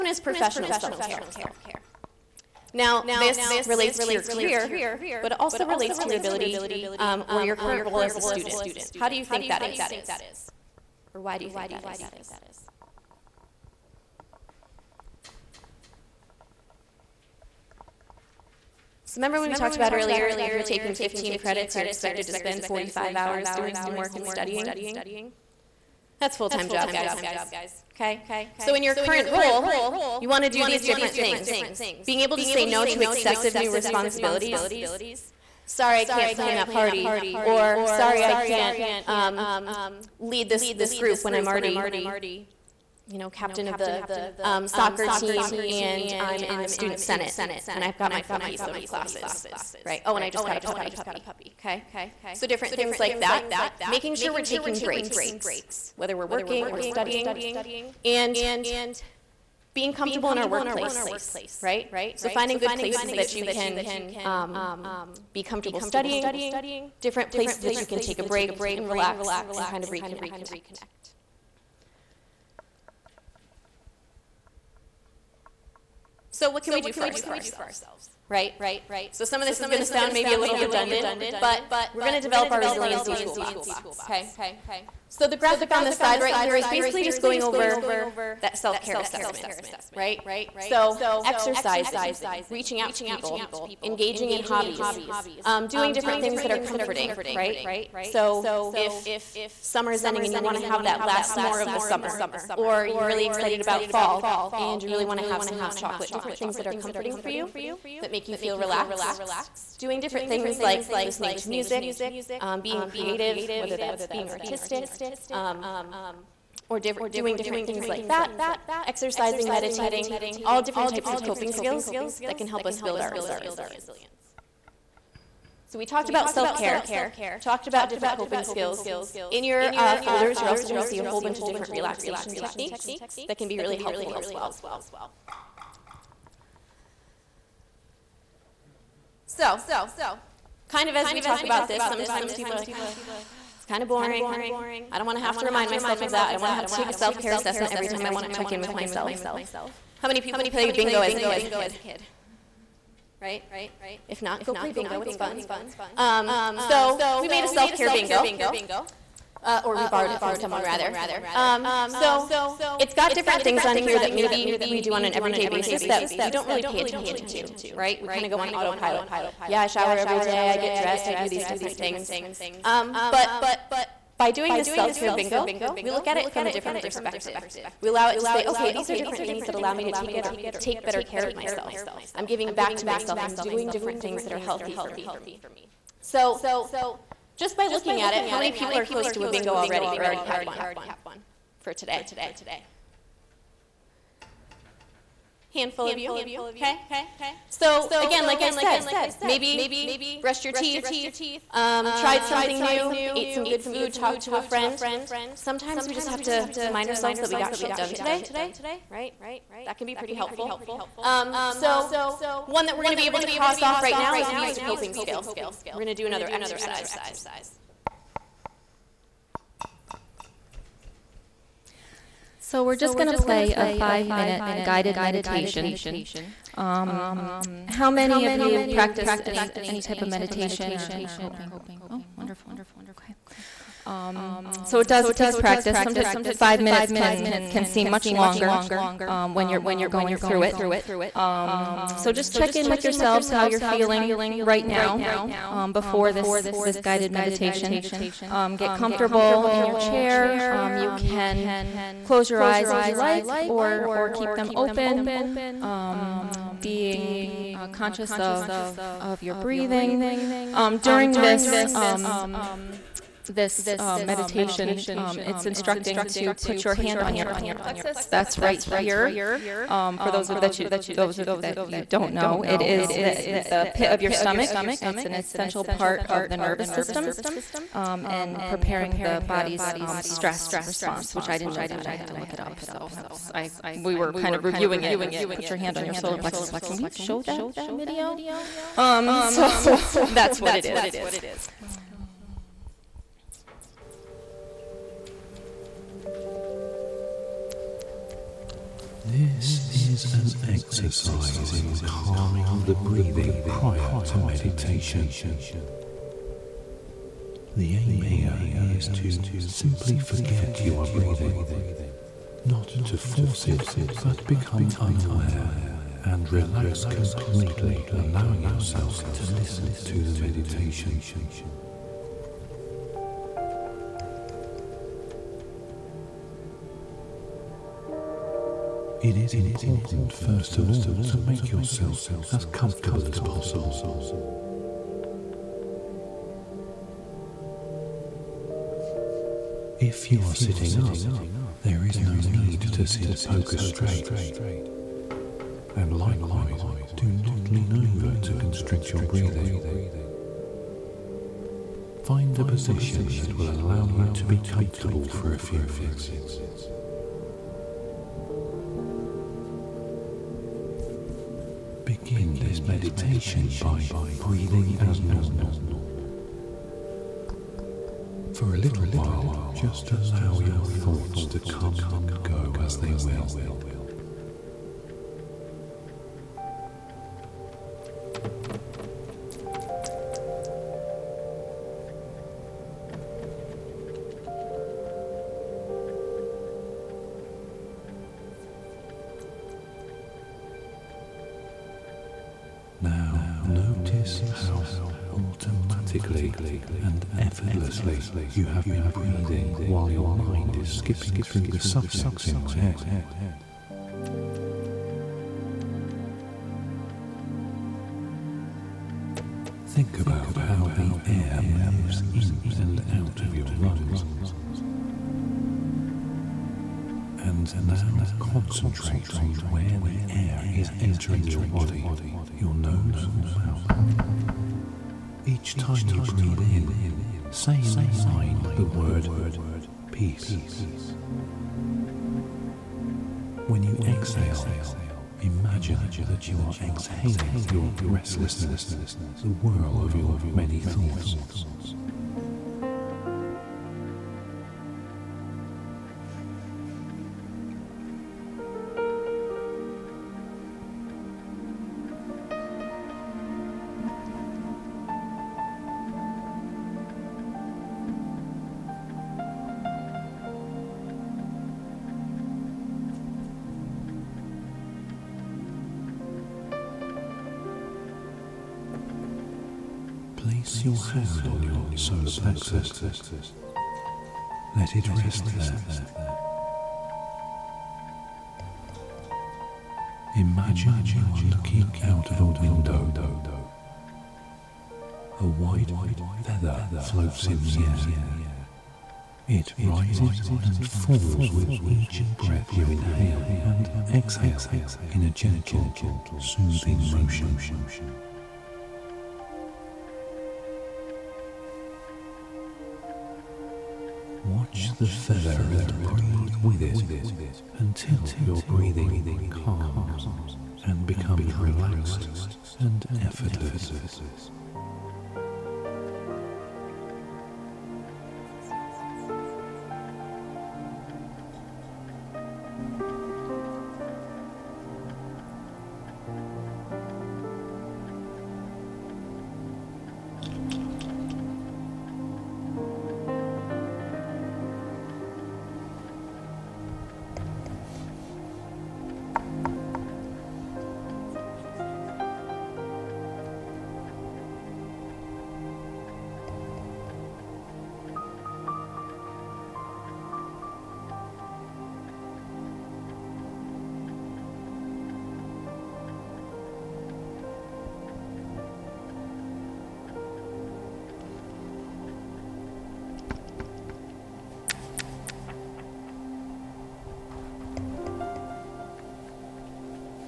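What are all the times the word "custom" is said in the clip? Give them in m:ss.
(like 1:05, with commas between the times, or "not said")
not said.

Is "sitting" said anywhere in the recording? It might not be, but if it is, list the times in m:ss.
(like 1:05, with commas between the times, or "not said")
5:40.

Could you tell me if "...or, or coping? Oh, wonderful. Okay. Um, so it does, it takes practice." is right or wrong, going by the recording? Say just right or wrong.
right.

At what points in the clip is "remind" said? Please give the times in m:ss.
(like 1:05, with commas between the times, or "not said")
2:25, 3:26.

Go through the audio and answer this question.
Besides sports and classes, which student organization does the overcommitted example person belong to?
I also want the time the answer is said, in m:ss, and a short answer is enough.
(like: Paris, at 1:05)
student senate, at 0:46.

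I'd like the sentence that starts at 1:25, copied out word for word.
So the graphic on this side right here is basically just going over that self-care assessment, right?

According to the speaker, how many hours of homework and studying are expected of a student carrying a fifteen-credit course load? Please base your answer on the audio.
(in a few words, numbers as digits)
45.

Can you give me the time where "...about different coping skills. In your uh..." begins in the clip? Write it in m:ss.
2:07.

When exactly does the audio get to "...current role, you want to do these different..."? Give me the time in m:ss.
0:28.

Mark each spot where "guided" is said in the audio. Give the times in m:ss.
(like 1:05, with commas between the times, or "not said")
3:44, 4:06.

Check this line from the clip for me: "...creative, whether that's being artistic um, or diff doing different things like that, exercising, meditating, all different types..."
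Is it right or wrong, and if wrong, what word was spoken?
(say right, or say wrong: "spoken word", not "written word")
right.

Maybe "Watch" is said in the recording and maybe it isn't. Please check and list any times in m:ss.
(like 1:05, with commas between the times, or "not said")
8:24.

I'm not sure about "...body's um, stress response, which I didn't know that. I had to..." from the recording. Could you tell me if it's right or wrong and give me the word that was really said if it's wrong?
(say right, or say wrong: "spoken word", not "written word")
right.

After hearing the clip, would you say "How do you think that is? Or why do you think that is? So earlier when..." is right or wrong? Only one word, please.
wrong.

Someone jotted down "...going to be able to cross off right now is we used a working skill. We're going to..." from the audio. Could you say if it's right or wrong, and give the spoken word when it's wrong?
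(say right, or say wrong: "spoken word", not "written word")
wrong: "coping", not "working".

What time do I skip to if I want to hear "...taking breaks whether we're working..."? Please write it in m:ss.
0:54.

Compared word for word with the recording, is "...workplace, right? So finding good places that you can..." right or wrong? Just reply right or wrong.
right.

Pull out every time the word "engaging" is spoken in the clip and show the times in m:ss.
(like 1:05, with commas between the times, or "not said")
1:33.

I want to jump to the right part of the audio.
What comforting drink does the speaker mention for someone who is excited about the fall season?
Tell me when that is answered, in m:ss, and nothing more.
1:45.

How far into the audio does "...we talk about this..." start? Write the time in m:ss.
2:21.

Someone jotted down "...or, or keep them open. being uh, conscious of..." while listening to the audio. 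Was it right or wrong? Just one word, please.
right.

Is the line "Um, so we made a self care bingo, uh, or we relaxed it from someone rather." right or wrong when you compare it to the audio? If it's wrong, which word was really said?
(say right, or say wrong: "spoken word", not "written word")
wrong: "borrowed", not "relaxed".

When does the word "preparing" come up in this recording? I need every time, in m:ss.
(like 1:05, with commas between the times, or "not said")
4:38.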